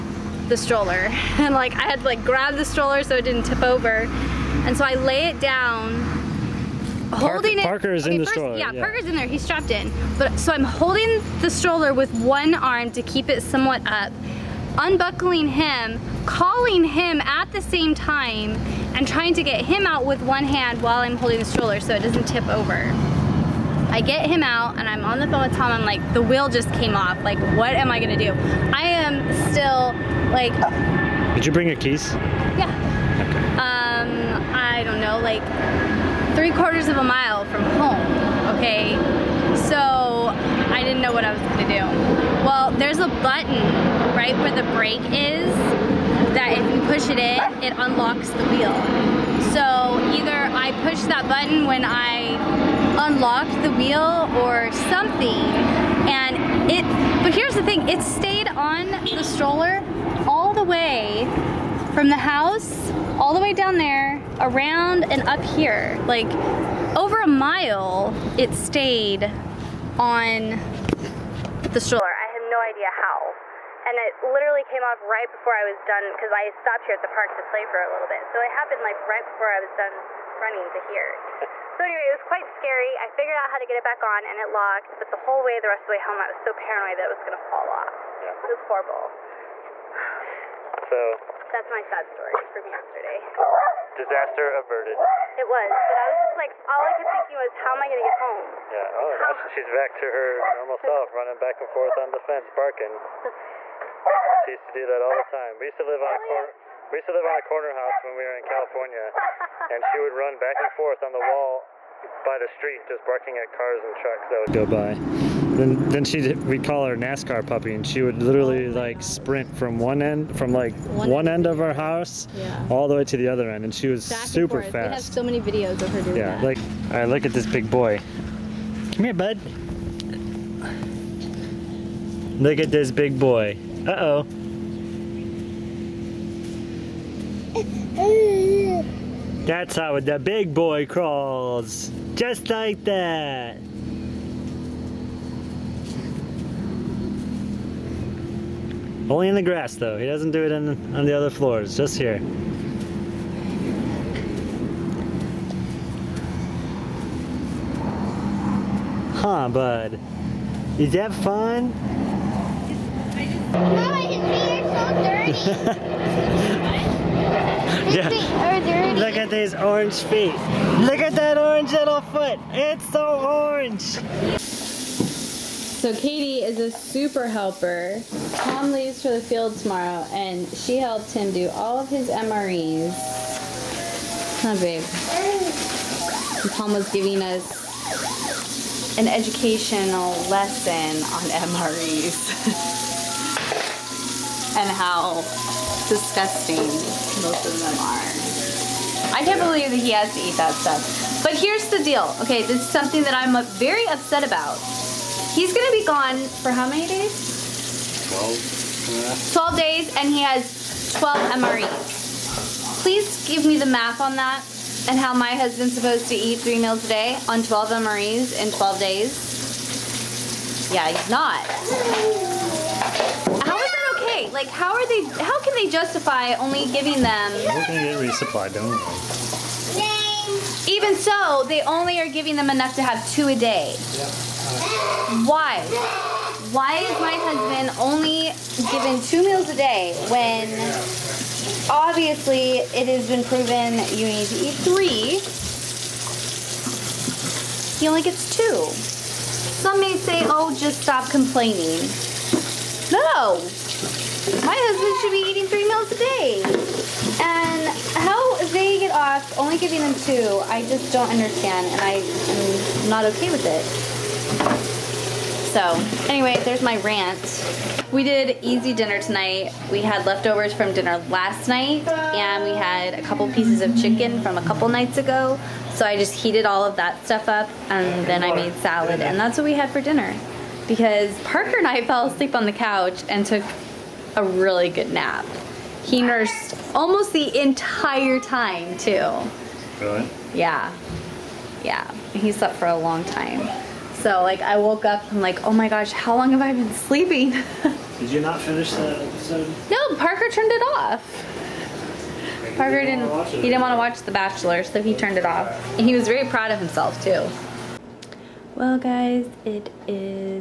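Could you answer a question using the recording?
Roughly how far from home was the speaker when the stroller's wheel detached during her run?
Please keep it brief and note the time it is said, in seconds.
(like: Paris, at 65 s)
three quarters of a mile, at 36 s.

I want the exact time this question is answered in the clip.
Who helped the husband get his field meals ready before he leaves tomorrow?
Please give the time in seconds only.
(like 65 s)
175 s.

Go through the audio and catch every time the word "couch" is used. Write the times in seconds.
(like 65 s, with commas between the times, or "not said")
282 s.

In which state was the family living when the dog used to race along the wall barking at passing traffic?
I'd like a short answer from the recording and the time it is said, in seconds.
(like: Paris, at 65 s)
California, at 108 s.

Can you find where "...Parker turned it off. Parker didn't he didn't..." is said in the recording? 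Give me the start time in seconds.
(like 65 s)
299 s.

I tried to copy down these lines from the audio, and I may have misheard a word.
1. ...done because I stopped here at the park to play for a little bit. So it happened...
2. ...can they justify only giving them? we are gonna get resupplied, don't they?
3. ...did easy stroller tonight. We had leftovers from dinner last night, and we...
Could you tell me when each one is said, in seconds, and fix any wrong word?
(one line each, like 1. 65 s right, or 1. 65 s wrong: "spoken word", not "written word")
1. 75 s right
2. 225 s right
3. 268 s wrong: "dinner", not "stroller".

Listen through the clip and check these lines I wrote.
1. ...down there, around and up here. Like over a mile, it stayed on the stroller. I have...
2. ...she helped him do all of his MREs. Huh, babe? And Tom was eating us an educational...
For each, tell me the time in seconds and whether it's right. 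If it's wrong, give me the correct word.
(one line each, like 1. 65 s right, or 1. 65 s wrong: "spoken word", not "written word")
1. 63 s right
2. 180 s wrong: "giving", not "eating".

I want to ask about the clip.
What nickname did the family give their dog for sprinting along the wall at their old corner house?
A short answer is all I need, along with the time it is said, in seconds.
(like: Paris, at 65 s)
NASCAR puppy, at 116 s.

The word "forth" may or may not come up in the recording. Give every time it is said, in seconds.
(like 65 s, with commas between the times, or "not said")
101 s, 110 s.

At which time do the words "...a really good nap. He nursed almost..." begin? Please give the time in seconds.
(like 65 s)
284 s.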